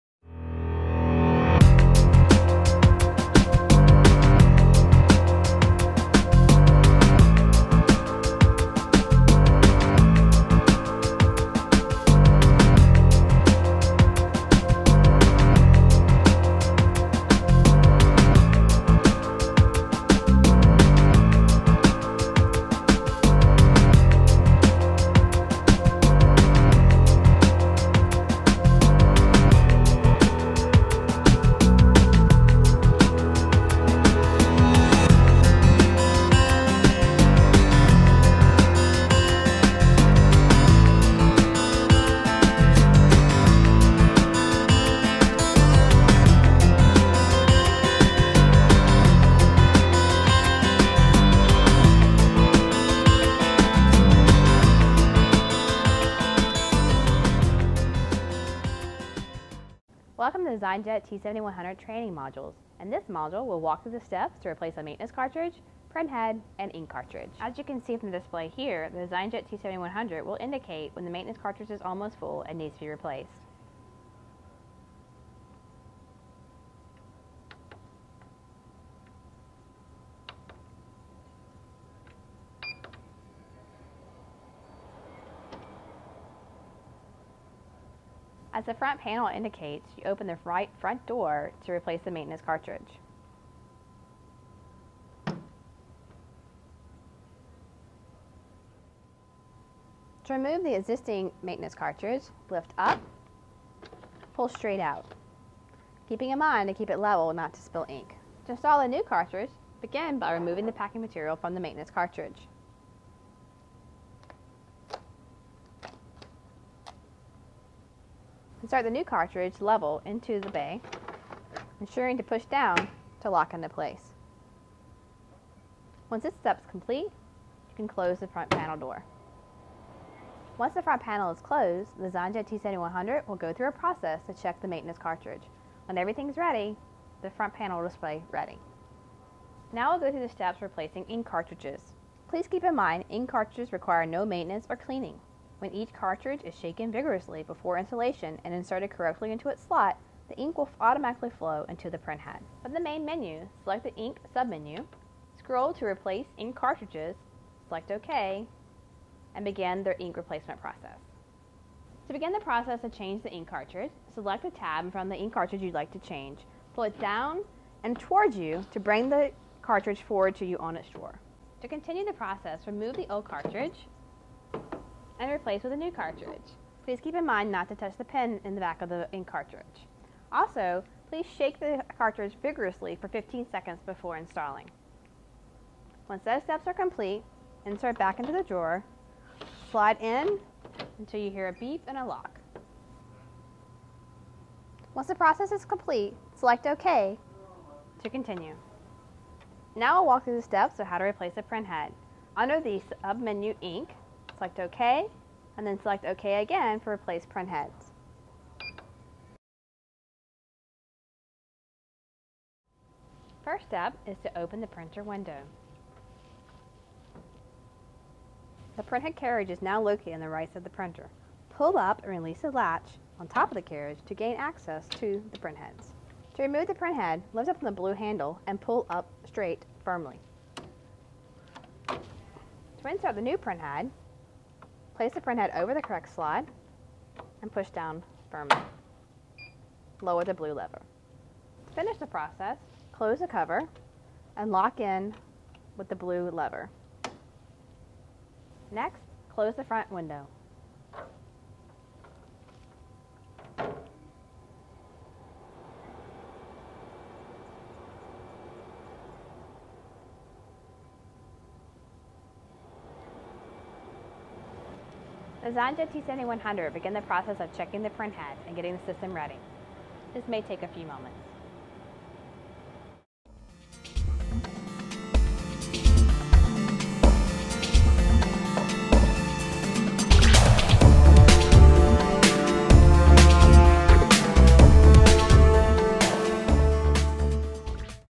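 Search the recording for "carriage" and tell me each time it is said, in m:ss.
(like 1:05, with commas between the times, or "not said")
3:39, 3:43.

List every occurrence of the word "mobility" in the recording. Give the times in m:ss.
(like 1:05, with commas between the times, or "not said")
not said.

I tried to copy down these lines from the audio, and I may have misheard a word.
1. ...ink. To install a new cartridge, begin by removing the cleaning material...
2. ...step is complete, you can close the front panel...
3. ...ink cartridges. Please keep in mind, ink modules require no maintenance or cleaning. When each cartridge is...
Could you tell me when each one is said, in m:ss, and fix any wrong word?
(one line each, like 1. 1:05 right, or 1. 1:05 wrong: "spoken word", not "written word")
1. 1:47 wrong: "packing", not "cleaning"
2. 2:06 right
3. 2:21 wrong: "cartridges", not "modules".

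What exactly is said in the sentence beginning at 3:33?
First step is to open the printer window.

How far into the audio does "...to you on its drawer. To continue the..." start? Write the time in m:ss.
2:50.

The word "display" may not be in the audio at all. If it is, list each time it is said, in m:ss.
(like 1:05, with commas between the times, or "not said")
1:08, 2:17.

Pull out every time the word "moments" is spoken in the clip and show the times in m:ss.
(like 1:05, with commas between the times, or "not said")
4:30.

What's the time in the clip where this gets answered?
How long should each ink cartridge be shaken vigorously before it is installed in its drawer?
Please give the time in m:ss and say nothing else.
3:03.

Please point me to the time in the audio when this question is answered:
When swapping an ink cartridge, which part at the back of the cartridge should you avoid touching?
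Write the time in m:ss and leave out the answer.
2:57.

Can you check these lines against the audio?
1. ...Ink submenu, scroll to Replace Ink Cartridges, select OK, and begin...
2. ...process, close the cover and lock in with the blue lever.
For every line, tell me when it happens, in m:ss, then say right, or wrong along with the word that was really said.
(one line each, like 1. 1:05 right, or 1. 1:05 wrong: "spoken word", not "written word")
1. 2:33 right
2. 4:02 right.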